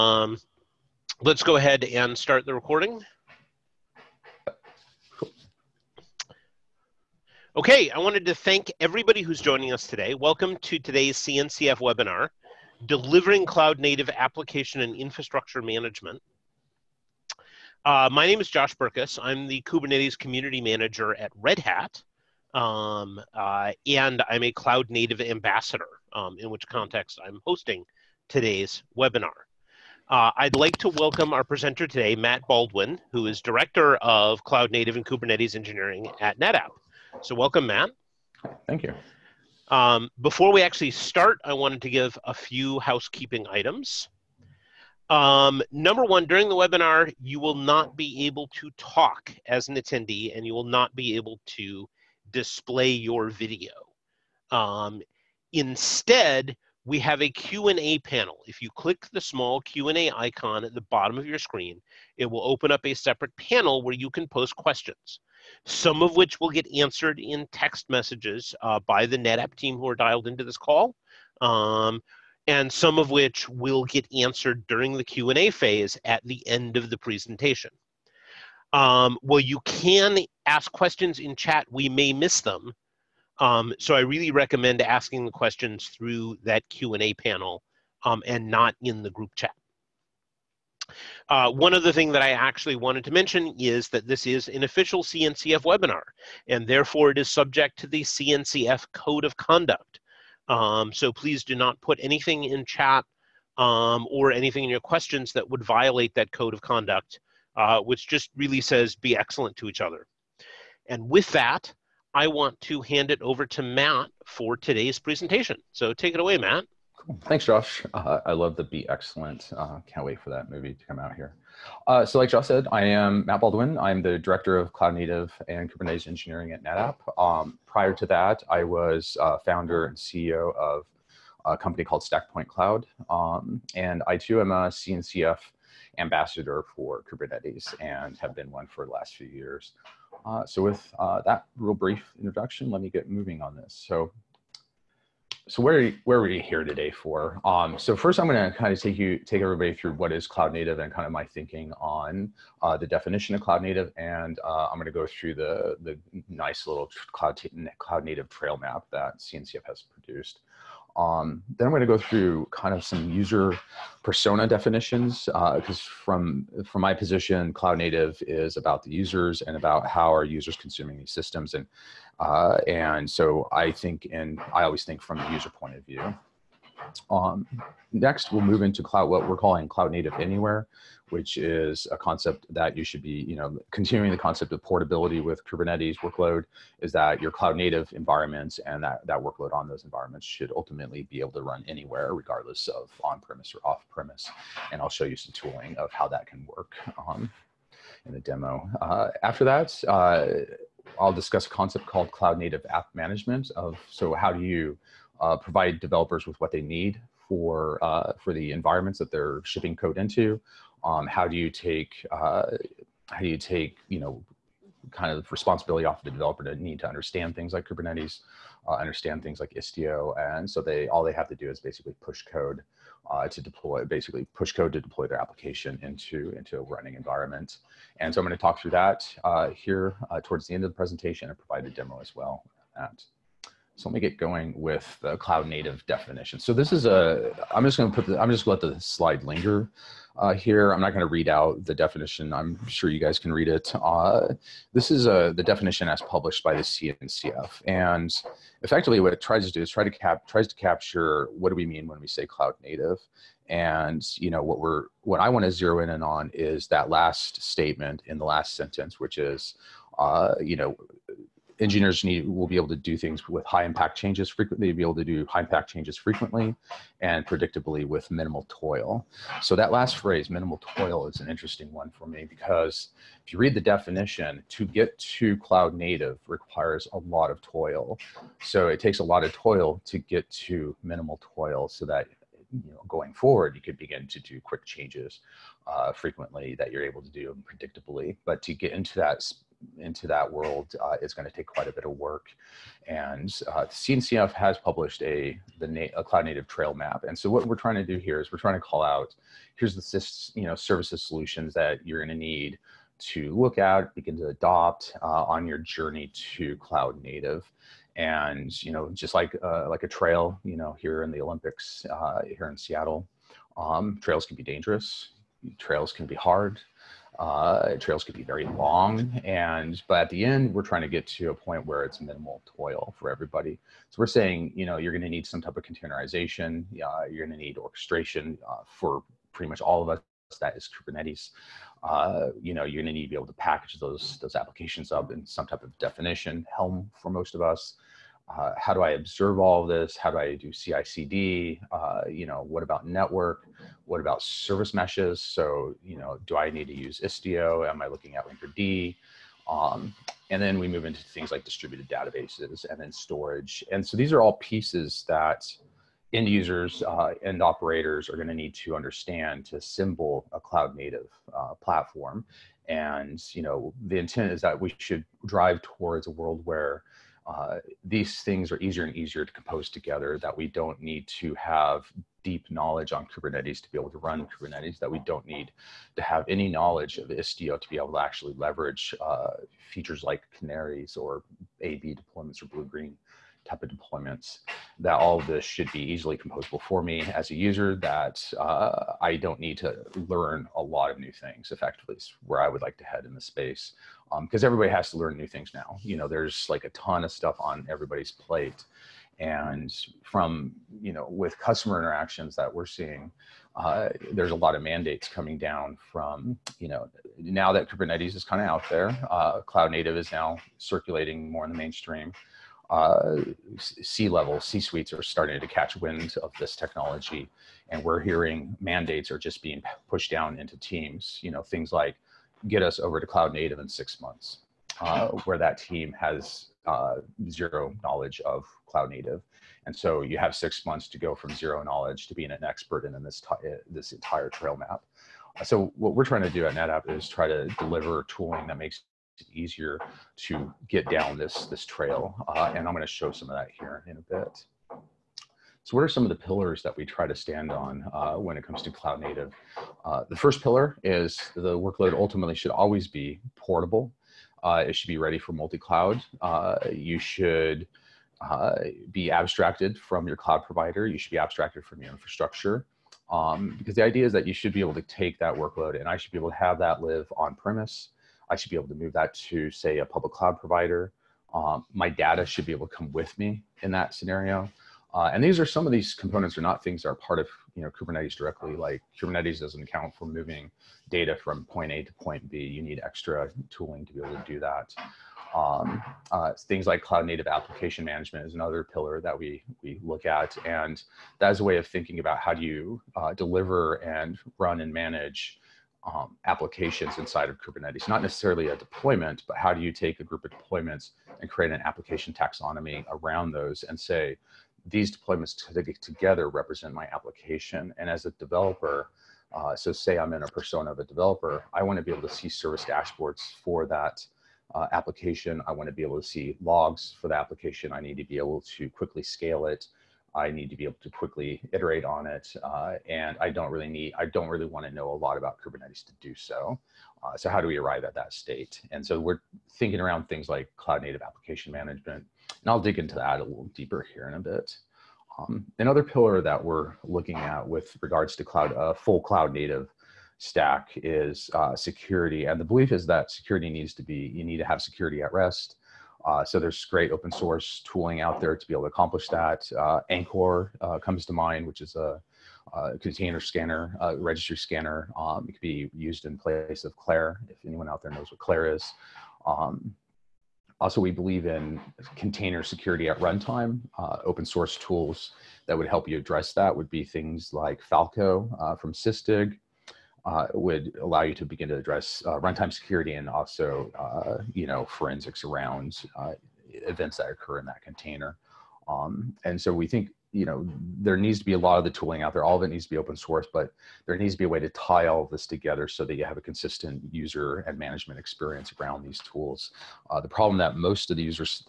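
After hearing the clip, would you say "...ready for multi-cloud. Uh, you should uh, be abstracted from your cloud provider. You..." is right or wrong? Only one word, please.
right.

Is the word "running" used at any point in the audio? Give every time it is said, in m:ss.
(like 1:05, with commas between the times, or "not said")
3:46.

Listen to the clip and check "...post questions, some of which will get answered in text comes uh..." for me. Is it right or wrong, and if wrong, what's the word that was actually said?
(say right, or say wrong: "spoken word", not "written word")
wrong: "messages", not "comes".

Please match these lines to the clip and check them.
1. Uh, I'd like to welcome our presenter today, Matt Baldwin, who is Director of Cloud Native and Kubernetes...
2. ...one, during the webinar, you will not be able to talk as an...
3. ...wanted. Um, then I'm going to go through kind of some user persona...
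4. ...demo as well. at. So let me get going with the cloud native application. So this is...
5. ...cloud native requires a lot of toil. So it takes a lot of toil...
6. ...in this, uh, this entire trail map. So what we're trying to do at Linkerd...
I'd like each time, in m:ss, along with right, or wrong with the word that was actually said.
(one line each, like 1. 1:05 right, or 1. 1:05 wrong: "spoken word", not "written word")
1. 0:30 right
2. 0:46 right
3. 2:39 wrong: "produced", not "wanted"
4. 3:51 wrong: "definition", not "application"
5. 4:35 right
6. 7:12 wrong: "NetApp", not "Linkerd".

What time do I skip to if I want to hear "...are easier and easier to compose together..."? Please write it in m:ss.
6:08.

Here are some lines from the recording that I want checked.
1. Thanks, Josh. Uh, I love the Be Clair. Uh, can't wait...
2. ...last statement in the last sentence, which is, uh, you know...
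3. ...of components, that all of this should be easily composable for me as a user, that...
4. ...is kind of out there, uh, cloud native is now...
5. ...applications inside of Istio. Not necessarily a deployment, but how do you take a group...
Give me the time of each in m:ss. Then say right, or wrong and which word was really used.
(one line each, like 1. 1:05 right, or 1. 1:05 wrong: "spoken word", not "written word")
1. 1:57 wrong: "Excellent", not "Clair"
2. 4:16 right
3. 6:23 wrong: "deployments", not "components"
4. 6:48 right
5. 8:16 wrong: "Kubernetes", not "Istio".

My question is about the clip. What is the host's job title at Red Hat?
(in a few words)
Kubernetes Community Manager.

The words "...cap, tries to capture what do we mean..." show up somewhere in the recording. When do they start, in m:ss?
4:09.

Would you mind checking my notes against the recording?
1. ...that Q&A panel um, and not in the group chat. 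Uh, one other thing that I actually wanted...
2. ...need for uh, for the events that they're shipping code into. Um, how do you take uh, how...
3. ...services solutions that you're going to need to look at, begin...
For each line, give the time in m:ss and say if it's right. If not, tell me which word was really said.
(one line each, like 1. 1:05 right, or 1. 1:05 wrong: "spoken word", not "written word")
1. 1:26 right
2. 3:26 wrong: "environments", not "events"
3. 5:00 right.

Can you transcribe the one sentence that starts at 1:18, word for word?
Um, well, you can ask questions in chat.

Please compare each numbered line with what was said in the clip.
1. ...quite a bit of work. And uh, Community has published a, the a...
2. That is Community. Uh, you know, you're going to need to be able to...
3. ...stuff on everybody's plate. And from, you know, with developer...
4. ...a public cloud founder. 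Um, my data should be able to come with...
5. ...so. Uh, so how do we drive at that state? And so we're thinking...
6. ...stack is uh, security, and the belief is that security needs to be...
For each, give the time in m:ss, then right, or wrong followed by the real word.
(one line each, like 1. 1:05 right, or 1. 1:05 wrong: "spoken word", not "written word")
1. 4:51 wrong: "CNCF", not "Community"
2. 5:30 wrong: "Kubernetes", not "Community"
3. 6:37 wrong: "customer", not "developer"
4. 7:49 wrong: "provider", not "founder"
5. 8:46 wrong: "arrive", not "drive"
6. 9:00 right.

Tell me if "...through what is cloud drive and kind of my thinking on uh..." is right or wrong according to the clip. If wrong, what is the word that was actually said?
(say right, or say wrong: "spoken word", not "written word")
wrong: "native", not "drive".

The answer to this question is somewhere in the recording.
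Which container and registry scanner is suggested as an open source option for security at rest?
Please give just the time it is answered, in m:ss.
9:09.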